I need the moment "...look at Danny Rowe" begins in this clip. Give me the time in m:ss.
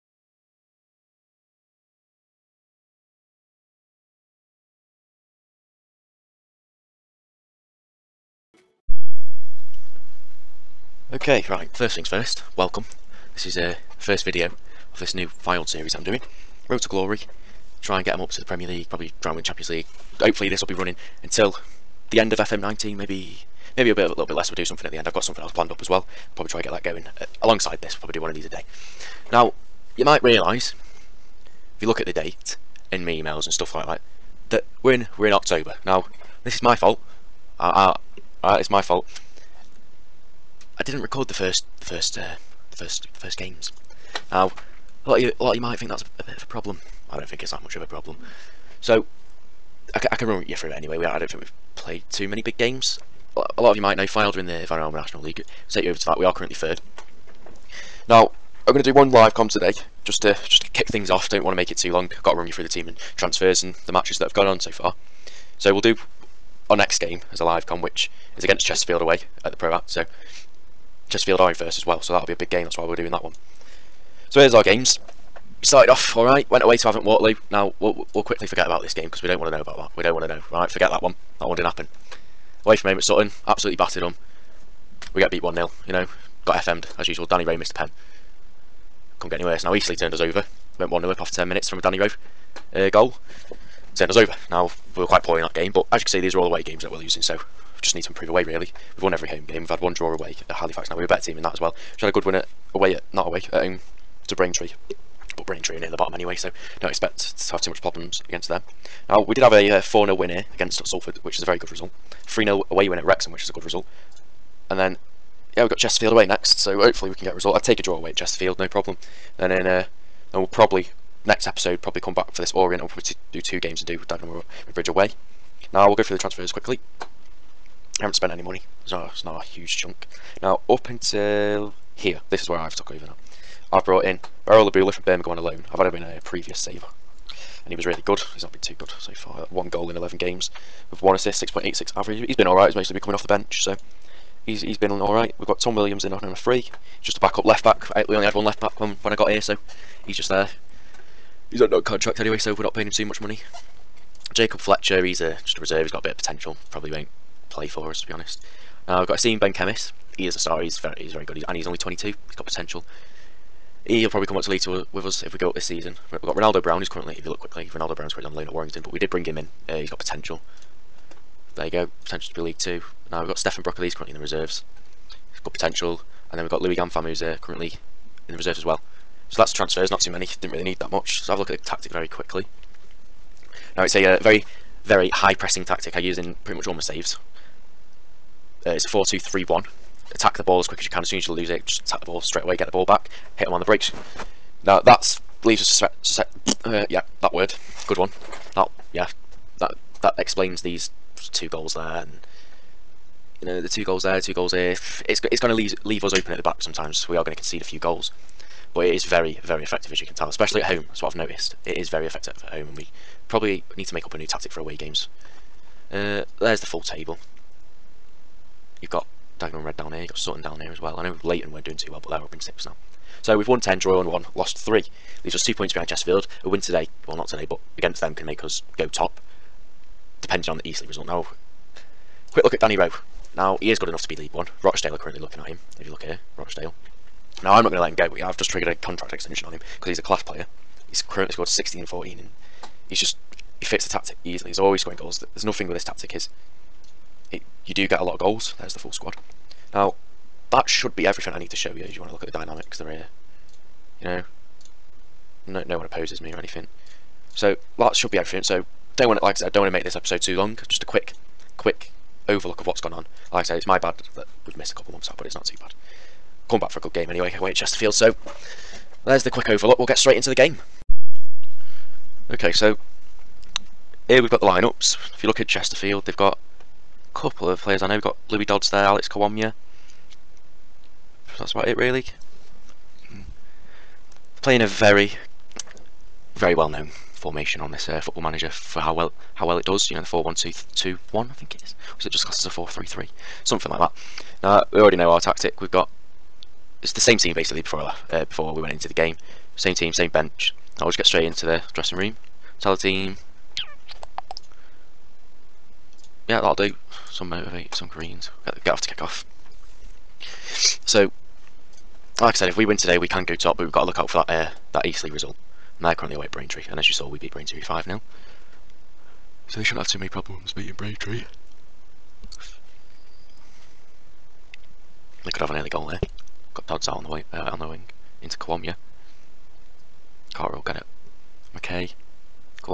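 3:52.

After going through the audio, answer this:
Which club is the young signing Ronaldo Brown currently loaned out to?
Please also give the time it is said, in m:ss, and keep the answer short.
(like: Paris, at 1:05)
Warrington, at 2:48.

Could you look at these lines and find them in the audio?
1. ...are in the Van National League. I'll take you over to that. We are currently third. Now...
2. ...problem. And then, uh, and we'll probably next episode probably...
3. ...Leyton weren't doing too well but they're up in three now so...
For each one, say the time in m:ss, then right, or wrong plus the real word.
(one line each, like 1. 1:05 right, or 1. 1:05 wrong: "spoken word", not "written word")
1. 0:54 right
2. 1:58 right
3. 3:41 wrong: "six", not "three".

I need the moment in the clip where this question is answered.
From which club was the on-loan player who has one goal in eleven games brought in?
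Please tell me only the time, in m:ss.
2:15.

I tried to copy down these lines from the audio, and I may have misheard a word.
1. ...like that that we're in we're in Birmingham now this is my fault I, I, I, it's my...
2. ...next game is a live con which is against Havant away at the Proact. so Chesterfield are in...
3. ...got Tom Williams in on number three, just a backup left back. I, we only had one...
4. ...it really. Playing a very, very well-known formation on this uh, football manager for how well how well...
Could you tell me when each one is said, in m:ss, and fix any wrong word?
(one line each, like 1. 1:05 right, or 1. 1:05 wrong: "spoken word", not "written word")
1. 0:33 wrong: "October", not "Birmingham"
2. 1:06 wrong: "Chesterfield", not "Havant"
3. 2:25 right
4. 4:41 right.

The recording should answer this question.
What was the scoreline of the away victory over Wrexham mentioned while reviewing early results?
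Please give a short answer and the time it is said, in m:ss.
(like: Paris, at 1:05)
3-0, at 1:52.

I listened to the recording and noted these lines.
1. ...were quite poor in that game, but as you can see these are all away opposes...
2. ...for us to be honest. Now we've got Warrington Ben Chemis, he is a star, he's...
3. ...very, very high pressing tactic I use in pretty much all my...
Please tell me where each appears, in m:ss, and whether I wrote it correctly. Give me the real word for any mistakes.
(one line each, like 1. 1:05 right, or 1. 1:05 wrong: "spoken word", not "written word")
1. 1:35 wrong: "games", not "opposes"
2. 2:37 wrong: "Asim", not "Warrington"
3. 3:04 right.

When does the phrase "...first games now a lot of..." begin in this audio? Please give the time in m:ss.
0:43.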